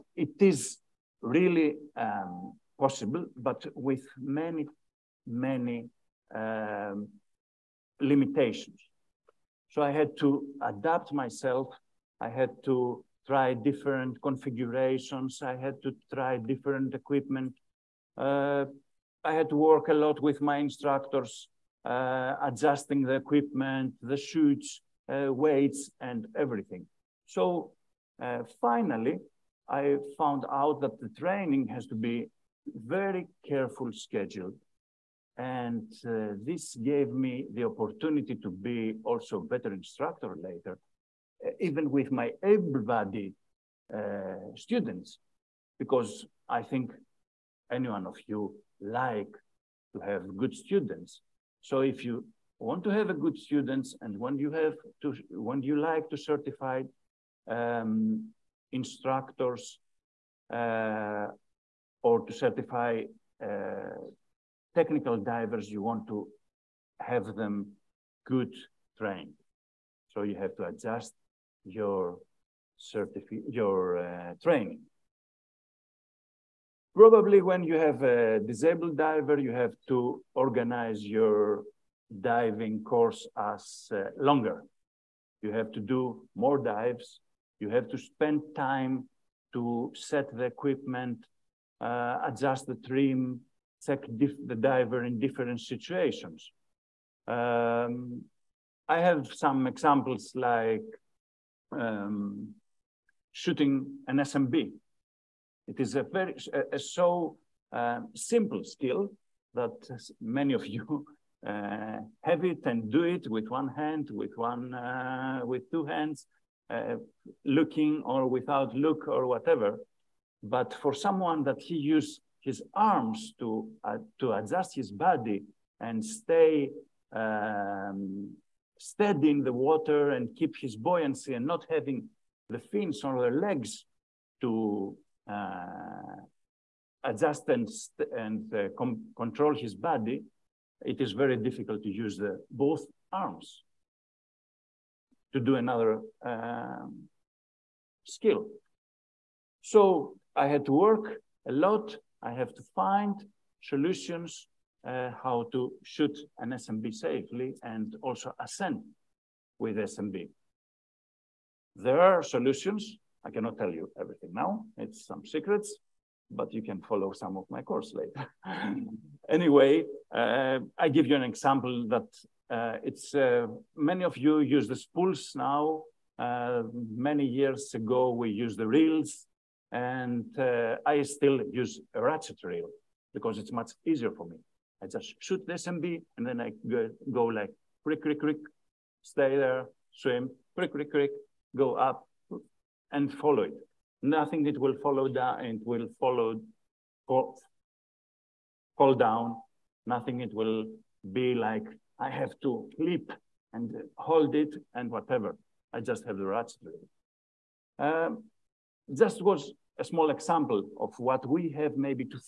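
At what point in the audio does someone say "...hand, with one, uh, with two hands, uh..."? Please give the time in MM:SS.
01:53.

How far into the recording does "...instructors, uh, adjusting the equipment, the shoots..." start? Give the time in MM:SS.
00:20.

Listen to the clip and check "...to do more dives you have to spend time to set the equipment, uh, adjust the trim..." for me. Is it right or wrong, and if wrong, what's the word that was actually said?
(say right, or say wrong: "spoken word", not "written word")
right.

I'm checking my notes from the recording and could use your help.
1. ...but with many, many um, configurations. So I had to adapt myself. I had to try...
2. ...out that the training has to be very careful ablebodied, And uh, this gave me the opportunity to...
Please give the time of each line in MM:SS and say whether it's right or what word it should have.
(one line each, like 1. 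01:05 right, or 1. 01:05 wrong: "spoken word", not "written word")
1. 00:03 wrong: "limitations", not "configurations"
2. 00:30 wrong: "scheduled", not "ablebodied".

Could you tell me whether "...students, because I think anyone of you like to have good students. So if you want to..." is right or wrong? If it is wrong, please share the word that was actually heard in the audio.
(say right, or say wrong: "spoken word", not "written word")
right.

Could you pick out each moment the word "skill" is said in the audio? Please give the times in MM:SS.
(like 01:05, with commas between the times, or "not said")
01:48, 02:28.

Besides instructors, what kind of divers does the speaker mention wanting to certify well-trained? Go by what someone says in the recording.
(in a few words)
technical divers.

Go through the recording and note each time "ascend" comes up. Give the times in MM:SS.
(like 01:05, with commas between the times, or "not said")
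02:38.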